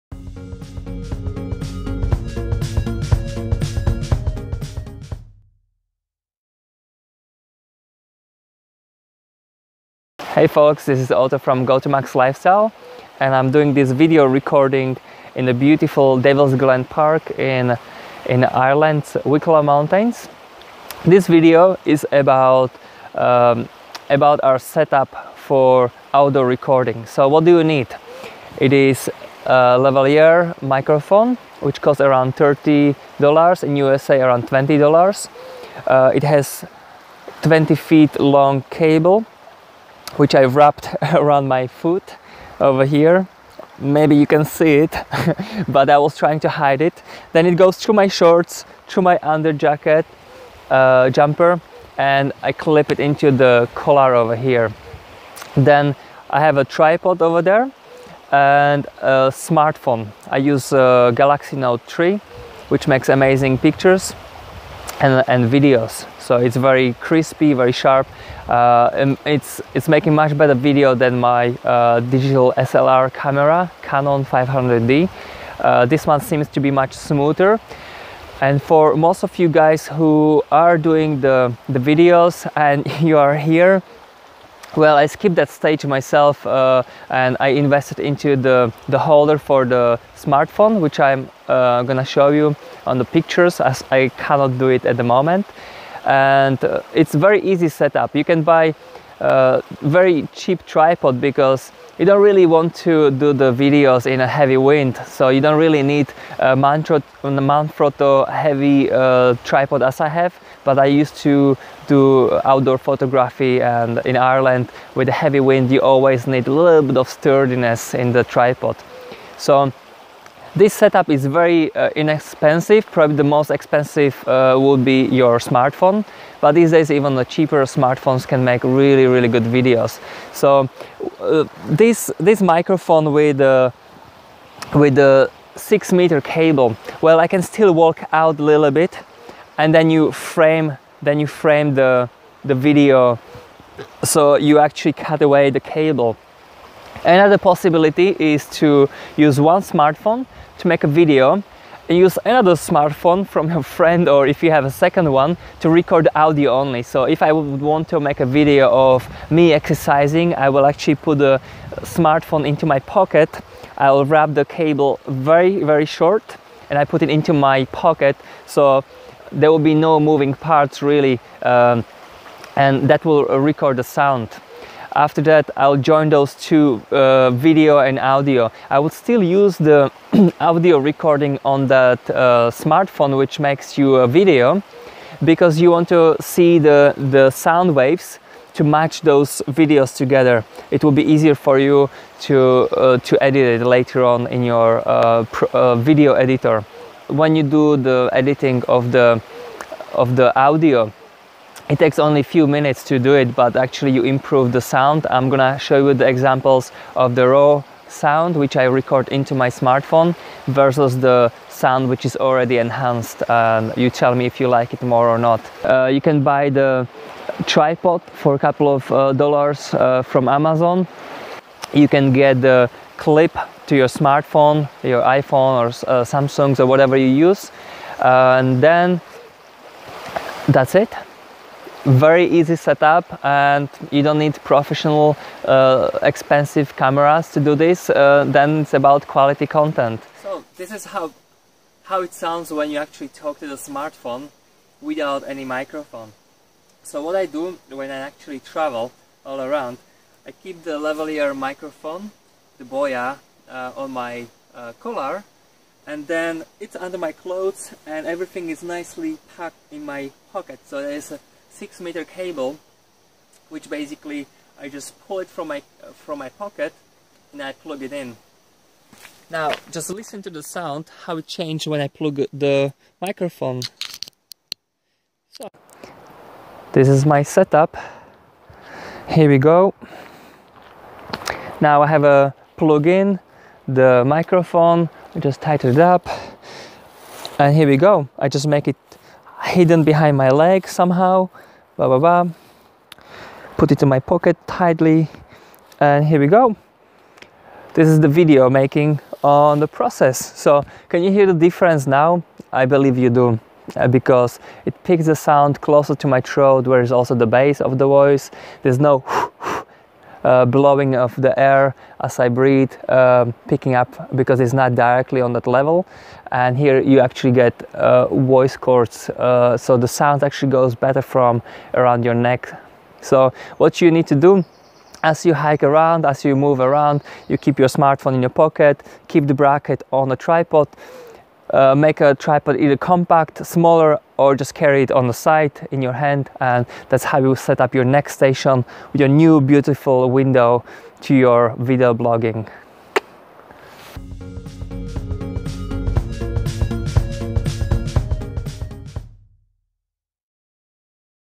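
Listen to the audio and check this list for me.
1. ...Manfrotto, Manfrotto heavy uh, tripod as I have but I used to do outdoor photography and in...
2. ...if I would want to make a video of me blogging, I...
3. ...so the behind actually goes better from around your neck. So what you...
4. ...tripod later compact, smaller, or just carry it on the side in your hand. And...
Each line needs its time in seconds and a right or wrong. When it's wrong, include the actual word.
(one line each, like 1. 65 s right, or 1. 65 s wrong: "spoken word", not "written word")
1. 106 s right
2. 157 s wrong: "exercising", not "blogging"
3. 319 s wrong: "sound", not "behind"
4. 332 s wrong: "either", not "later".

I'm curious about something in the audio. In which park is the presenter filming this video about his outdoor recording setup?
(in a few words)
Devil's Glen Park.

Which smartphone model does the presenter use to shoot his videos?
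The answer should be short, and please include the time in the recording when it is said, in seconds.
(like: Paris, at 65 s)
Galaxy Note 3, at 61 s.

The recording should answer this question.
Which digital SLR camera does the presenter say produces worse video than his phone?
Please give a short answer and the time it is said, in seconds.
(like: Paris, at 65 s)
Canon 500D, at 73 s.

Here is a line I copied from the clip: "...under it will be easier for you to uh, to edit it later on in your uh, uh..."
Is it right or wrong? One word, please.
wrong.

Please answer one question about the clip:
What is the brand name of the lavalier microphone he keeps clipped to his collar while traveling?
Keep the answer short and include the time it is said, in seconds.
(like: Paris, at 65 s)
Boya, at 252 s.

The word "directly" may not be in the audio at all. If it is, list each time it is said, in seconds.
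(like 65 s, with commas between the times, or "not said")
314 s.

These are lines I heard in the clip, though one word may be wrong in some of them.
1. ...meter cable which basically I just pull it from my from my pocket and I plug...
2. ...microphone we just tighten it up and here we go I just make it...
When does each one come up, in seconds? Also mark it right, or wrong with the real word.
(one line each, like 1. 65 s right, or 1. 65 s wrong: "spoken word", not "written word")
1. 261 s right
2. 284 s right.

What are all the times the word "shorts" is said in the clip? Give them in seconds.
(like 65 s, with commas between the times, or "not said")
48 s, 165 s.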